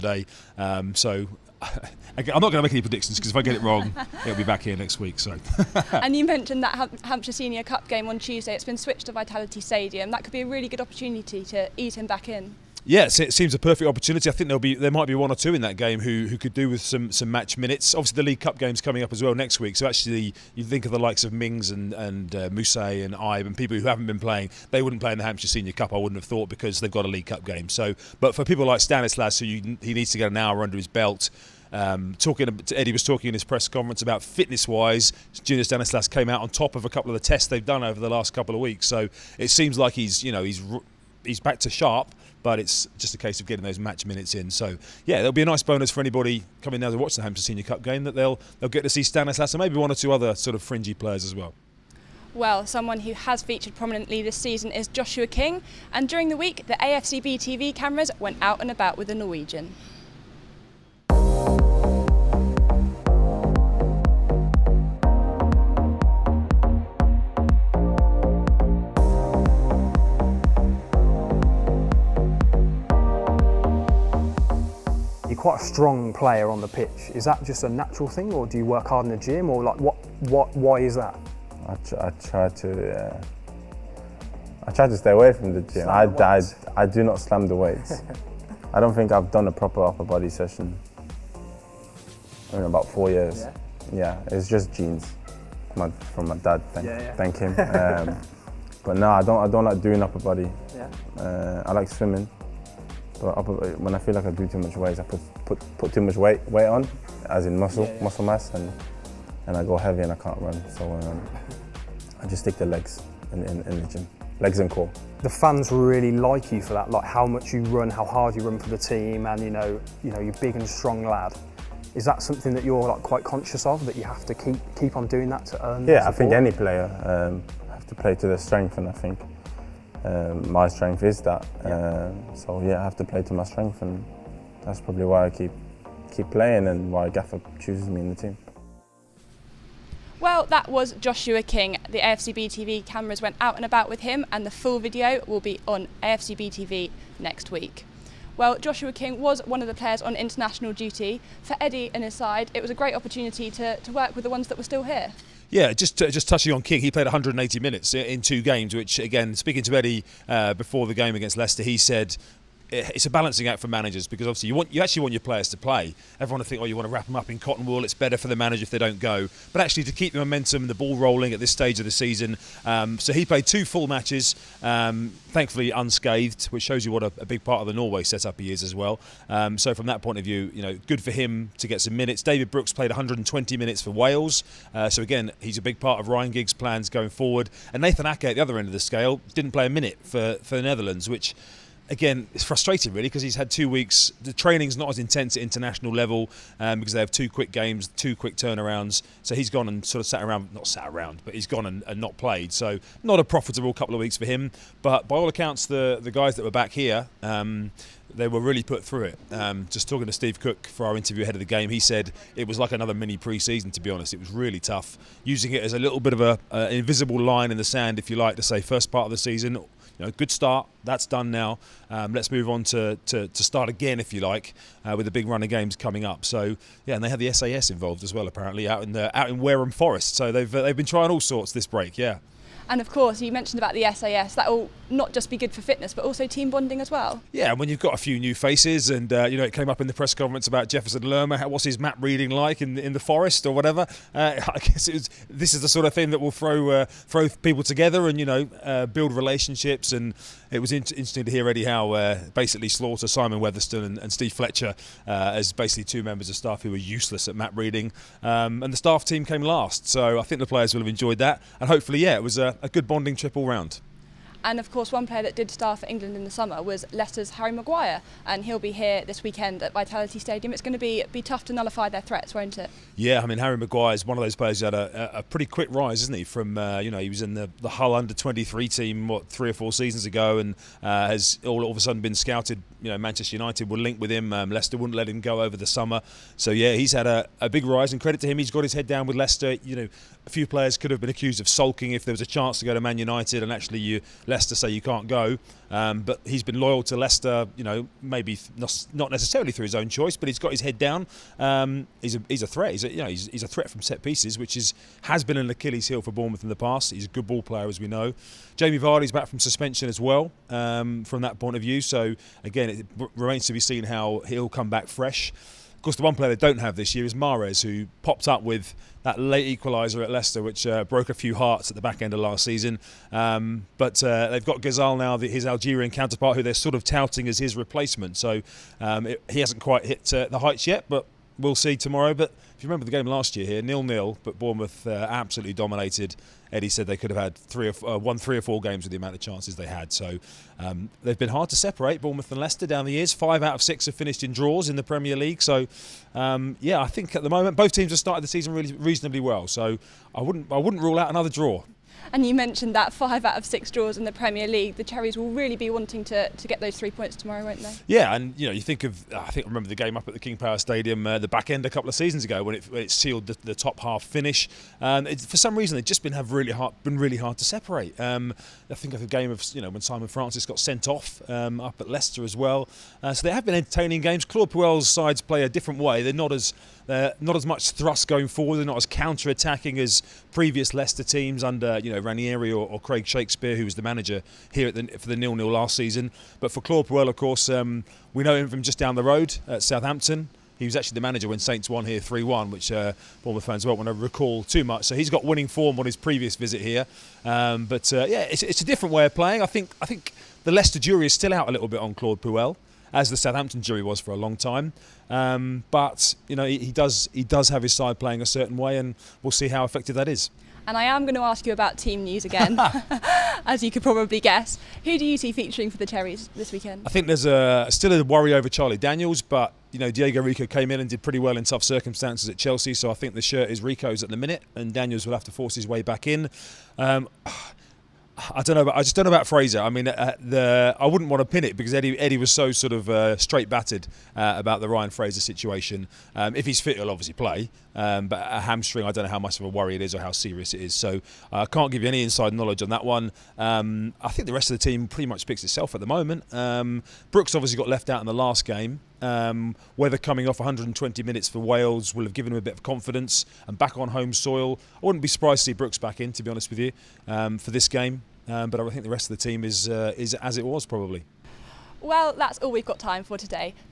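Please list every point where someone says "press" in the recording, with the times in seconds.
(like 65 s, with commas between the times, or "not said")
33 s, 239 s.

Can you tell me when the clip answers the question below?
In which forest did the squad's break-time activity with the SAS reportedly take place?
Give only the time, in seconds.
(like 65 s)
229 s.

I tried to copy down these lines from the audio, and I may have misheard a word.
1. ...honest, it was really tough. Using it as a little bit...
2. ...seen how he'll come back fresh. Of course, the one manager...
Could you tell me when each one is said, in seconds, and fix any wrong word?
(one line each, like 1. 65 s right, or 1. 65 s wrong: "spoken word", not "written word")
1. 213 s right
2. 313 s wrong: "player", not "manager".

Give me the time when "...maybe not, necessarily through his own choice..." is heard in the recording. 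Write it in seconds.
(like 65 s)
298 s.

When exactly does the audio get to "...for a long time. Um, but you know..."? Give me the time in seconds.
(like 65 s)
403 s.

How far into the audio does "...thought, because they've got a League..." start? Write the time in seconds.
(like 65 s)
26 s.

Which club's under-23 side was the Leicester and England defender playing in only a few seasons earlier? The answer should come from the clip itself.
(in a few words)
Hull.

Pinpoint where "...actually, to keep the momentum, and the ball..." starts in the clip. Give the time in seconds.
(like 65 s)
169 s.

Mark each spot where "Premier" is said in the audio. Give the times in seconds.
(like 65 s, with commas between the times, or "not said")
344 s, 354 s.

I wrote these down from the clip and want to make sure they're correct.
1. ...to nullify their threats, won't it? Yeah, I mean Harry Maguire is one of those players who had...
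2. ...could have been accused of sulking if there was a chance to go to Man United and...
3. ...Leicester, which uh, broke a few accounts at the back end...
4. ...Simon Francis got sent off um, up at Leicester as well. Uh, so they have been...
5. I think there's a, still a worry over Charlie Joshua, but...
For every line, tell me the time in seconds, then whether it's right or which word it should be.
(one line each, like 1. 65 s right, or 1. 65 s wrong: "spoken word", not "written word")
1. 271 s right
2. 290 s right
3. 320 s wrong: "hearts", not "accounts"
4. 369 s right
5. 416 s wrong: "Daniels", not "Joshua".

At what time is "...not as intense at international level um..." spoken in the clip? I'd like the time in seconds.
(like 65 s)
194 s.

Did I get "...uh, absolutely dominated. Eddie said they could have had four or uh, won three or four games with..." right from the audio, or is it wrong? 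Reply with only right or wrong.
wrong.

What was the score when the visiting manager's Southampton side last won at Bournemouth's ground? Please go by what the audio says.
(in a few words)
3-1.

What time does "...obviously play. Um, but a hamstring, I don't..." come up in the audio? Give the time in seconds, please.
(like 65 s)
436 s.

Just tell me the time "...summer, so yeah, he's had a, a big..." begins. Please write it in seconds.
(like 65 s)
285 s.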